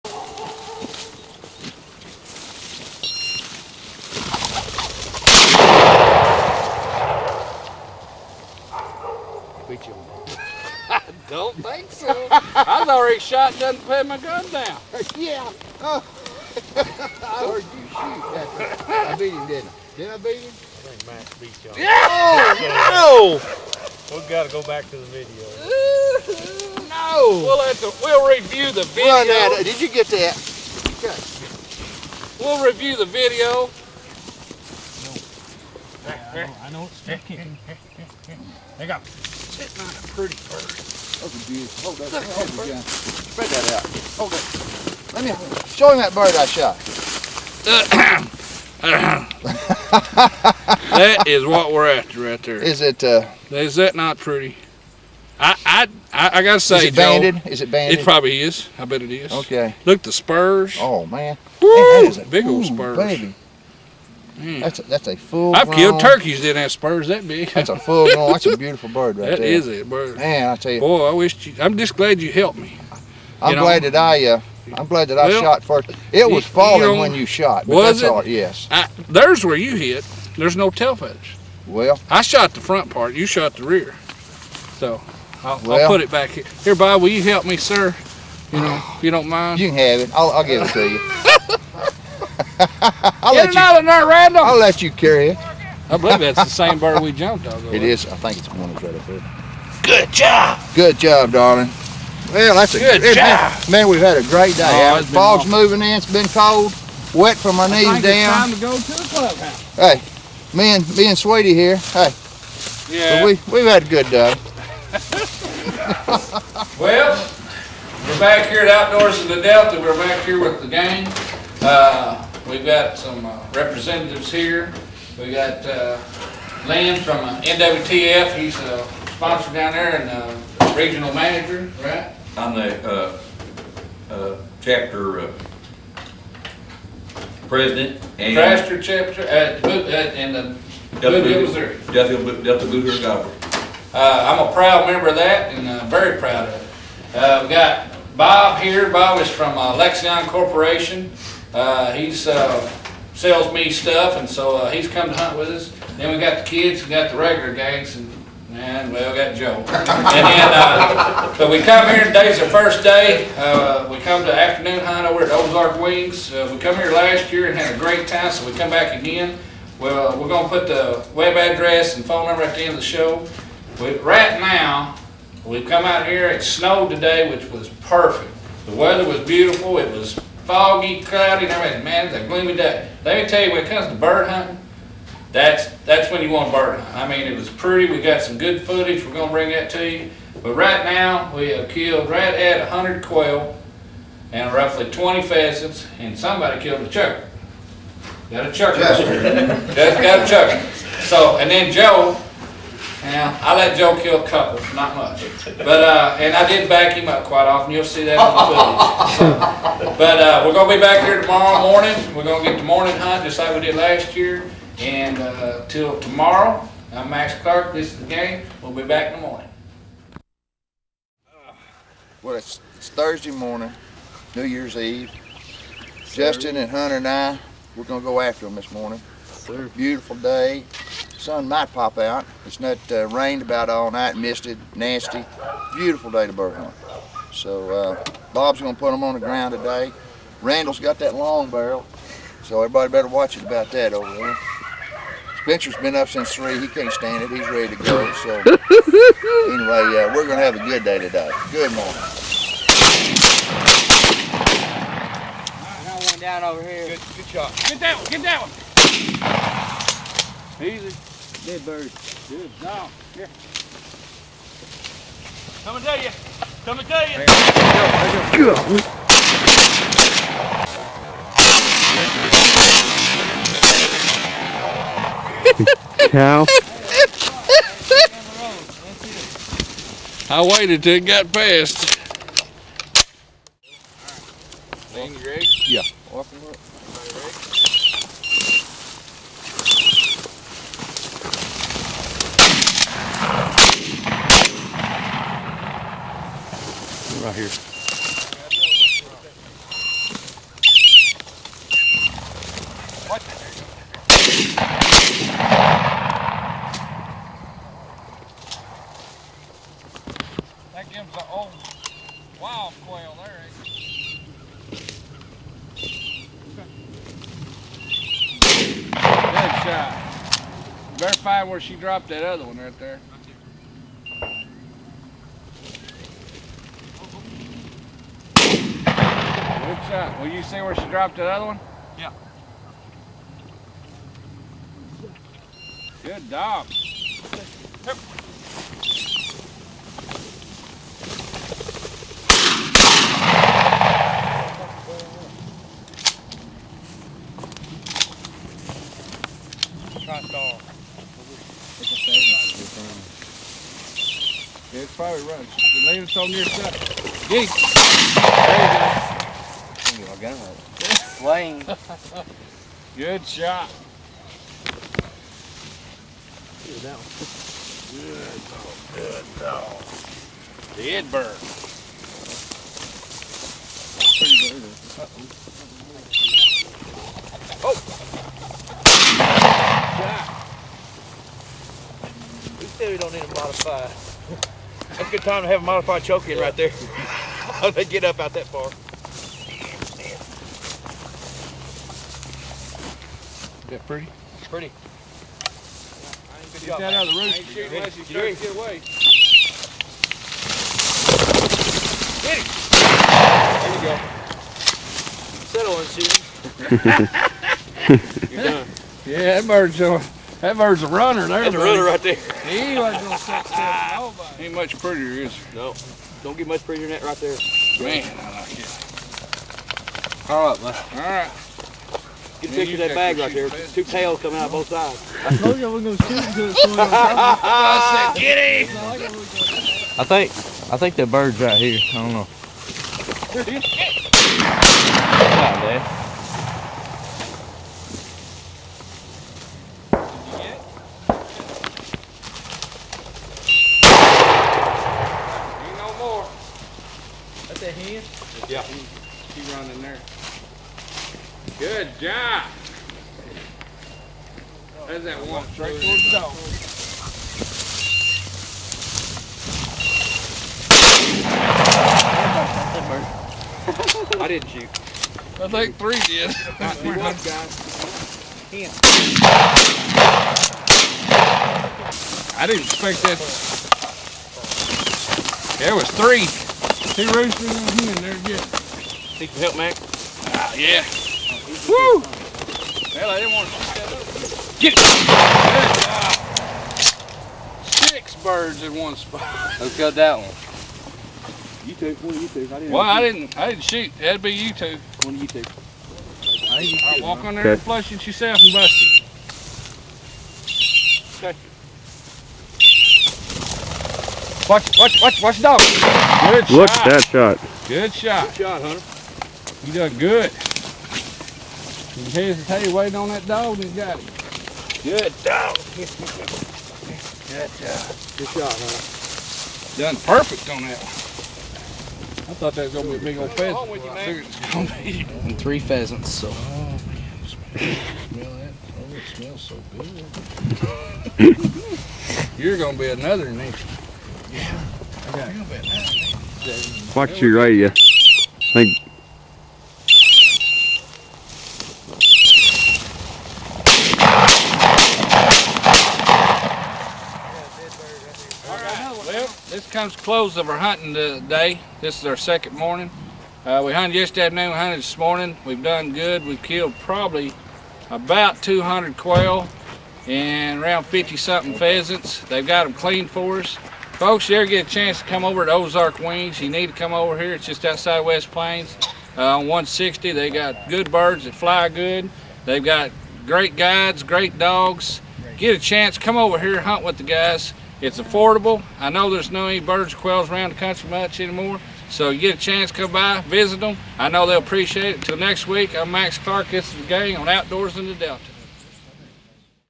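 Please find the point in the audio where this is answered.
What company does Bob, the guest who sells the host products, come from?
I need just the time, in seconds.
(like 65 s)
149 s.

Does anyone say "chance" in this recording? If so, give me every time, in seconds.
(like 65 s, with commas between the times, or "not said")
564 s, 575 s, 582 s.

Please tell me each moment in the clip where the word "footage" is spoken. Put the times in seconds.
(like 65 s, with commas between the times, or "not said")
188 s, 209 s.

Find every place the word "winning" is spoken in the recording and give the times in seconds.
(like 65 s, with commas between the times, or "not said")
not said.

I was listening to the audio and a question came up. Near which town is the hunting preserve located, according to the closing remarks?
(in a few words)
West Plains.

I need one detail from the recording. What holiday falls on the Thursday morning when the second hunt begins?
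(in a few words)
New Year's Eve.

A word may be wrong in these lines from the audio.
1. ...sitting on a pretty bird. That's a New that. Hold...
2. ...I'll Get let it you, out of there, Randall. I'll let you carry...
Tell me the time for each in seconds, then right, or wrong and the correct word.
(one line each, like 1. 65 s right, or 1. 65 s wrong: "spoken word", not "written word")
1. 39 s wrong: "Hold", not "New"
2. 92 s right.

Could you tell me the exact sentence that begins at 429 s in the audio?
I think, I think that bird's right here.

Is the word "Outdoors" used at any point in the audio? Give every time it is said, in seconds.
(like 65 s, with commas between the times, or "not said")
118 s, 587 s.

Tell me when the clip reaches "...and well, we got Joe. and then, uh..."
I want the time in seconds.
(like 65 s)
158 s.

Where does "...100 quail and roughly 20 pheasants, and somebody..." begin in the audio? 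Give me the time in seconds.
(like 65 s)
192 s.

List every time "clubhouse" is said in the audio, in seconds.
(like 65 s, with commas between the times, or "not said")
109 s.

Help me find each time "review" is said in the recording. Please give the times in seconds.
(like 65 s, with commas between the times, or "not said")
28 s, 32 s.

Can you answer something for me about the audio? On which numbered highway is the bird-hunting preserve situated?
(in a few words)
160.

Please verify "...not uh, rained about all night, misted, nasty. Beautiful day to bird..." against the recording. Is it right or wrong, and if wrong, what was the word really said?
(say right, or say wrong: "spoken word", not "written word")
right.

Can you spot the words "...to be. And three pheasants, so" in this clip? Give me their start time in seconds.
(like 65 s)
524 s.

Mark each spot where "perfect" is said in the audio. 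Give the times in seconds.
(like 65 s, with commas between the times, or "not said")
177 s, 520 s.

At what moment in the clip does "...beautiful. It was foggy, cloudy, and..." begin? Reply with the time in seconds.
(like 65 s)
179 s.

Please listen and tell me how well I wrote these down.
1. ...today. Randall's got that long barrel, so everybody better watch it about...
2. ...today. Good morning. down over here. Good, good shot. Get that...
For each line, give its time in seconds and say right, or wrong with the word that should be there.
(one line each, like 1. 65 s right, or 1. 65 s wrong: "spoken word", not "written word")
1. 239 s right
2. 250 s right.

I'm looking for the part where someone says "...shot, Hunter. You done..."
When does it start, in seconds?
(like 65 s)
508 s.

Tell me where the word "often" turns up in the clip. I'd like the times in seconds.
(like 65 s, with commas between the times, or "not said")
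207 s.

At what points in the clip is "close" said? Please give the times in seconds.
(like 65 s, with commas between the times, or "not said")
549 s.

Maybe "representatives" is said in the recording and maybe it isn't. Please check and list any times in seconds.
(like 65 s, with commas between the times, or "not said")
123 s.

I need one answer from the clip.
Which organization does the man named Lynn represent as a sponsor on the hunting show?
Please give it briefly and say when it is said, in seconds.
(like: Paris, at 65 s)
NWTF, at 127 s.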